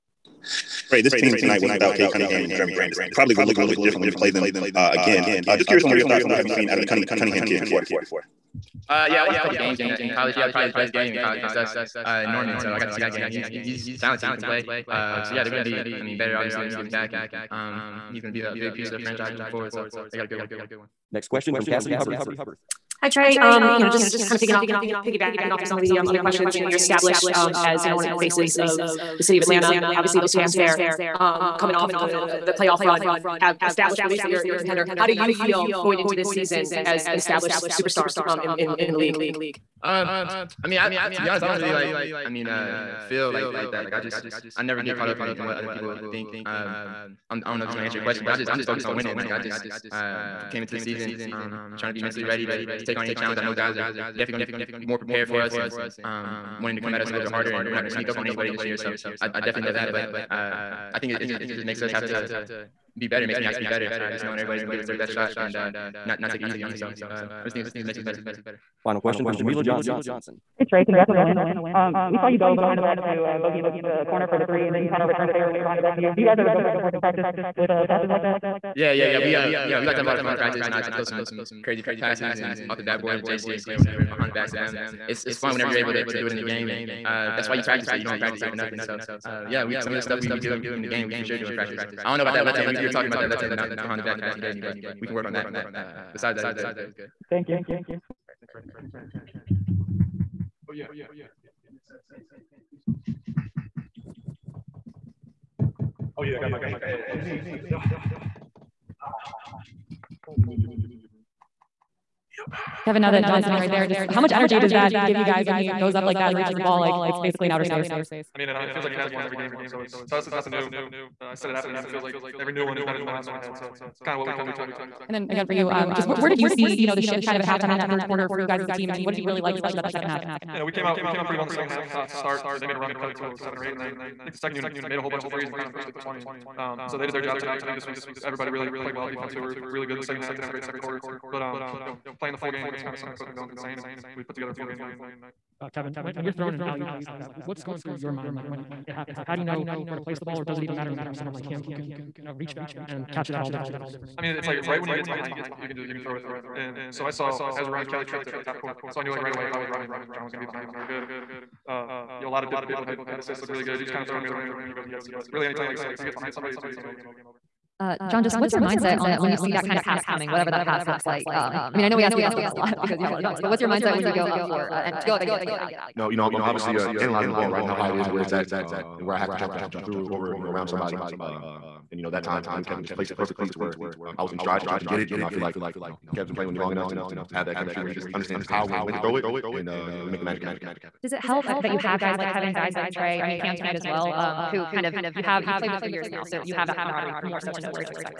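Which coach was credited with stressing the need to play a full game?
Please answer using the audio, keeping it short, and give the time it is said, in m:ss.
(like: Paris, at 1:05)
Coach McMillan, at 2:23.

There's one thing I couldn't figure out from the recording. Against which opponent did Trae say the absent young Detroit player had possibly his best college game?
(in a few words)
Norman.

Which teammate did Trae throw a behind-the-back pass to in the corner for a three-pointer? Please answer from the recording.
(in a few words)
Bogey.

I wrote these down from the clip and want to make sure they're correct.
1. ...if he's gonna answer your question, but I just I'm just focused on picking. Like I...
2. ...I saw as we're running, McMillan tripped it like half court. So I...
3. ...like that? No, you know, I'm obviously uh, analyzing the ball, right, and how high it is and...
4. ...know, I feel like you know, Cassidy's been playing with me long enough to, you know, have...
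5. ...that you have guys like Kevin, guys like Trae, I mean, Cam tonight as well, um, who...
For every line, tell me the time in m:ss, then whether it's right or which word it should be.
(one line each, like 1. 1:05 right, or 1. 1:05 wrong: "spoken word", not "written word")
1. 0:47 wrong: "winning", not "picking"
2. 2:37 wrong: "Kelly", not "McMillan"
3. 2:55 right
4. 3:05 wrong: "Kev", not "Cassidy"
5. 3:11 right.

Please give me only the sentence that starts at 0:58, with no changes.
So I, I definitely know that.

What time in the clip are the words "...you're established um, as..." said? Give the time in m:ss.
0:26.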